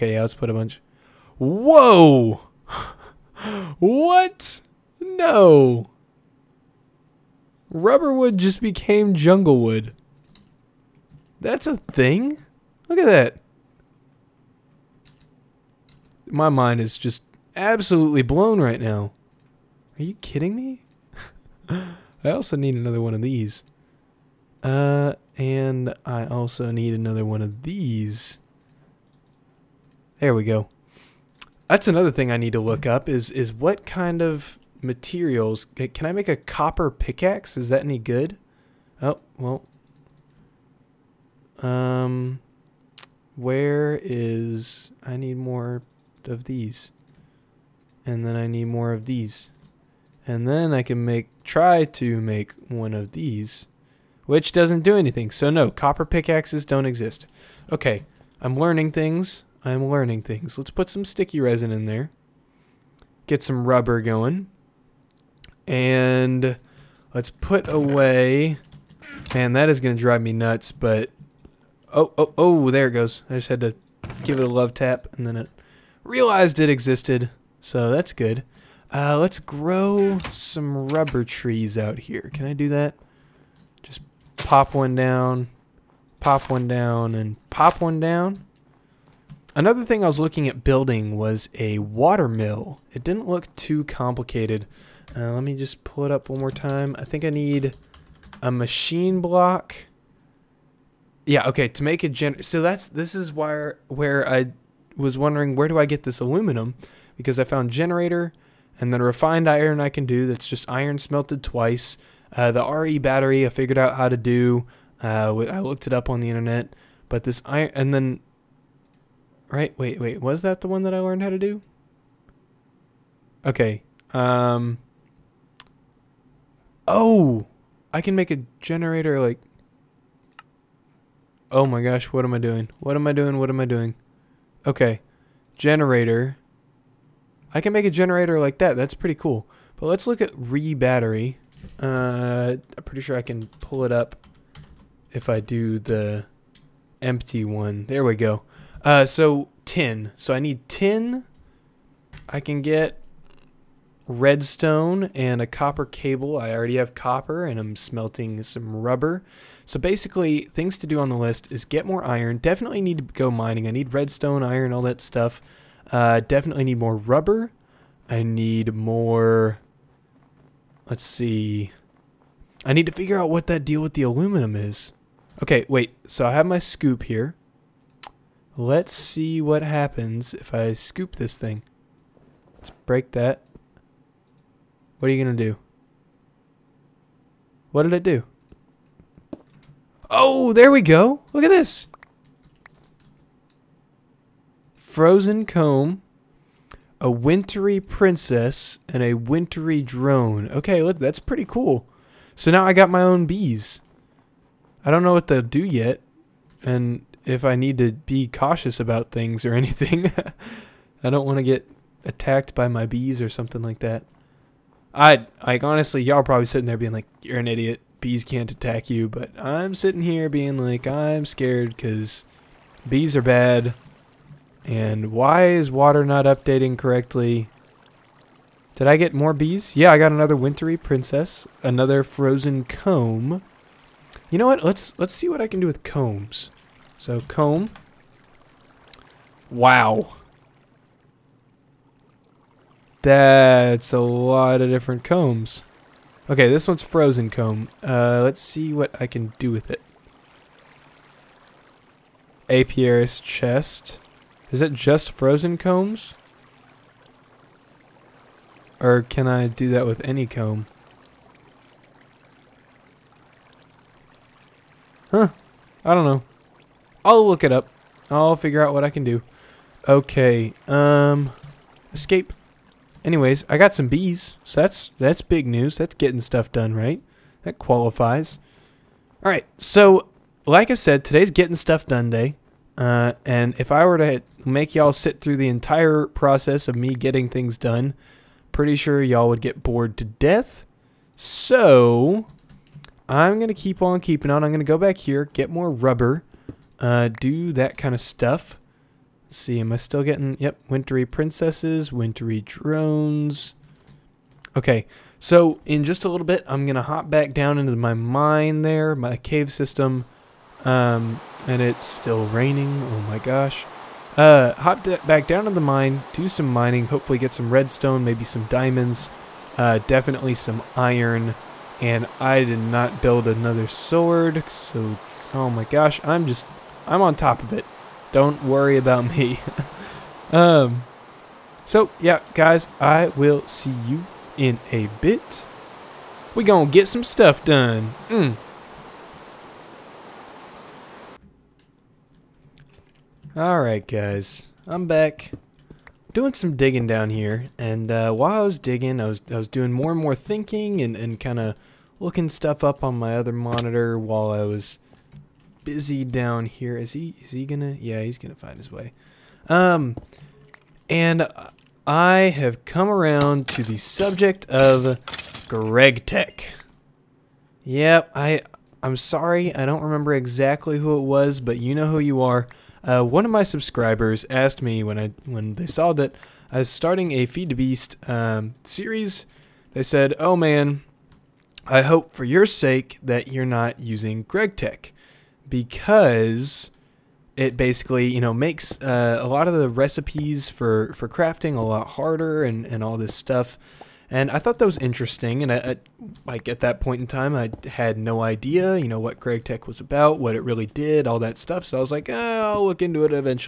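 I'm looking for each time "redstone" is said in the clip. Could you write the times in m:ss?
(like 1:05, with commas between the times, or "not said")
2:34, 2:43, 5:17.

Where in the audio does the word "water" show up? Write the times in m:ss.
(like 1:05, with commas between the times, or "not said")
1:31, 3:45.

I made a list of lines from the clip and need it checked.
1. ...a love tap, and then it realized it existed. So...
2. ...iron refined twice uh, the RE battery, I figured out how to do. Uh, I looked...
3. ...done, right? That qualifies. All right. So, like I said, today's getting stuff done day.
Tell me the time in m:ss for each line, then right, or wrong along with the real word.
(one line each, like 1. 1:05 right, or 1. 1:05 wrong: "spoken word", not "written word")
1. 1:14 right
2. 1:50 wrong: "smelted", not "refined"
3. 4:36 right.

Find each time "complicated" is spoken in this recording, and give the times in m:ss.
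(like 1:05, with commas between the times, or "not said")
1:33.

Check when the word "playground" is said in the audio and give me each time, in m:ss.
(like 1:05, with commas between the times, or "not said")
not said.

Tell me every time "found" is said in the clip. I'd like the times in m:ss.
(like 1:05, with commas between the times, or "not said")
1:47.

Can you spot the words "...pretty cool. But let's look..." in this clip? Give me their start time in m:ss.
2:18.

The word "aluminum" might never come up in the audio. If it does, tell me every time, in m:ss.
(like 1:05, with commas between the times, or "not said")
1:46, 2:54.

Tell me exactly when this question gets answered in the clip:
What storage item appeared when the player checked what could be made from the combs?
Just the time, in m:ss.
4:12.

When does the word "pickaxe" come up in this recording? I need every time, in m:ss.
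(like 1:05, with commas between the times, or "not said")
0:36, 0:56.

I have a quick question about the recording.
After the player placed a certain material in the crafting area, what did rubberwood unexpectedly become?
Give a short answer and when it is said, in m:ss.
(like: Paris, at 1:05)
jungle wood, at 0:09.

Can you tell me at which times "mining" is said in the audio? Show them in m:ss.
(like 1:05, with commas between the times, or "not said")
2:43, 5:16.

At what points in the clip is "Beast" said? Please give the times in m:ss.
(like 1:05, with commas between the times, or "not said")
6:17.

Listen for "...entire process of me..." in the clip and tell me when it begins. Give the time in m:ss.
4:45.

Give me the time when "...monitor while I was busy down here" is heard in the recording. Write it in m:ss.
5:53.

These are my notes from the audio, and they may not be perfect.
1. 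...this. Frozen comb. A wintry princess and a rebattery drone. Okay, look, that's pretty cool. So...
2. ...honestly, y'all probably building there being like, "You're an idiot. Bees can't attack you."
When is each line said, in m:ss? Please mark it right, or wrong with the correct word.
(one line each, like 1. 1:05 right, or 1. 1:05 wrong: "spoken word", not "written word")
1. 3:11 wrong: "wintry", not "rebattery"
2. 3:35 wrong: "sitting", not "building".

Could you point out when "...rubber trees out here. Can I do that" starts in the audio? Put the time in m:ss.
1:20.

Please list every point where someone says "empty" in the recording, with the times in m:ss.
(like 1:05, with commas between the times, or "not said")
2:27.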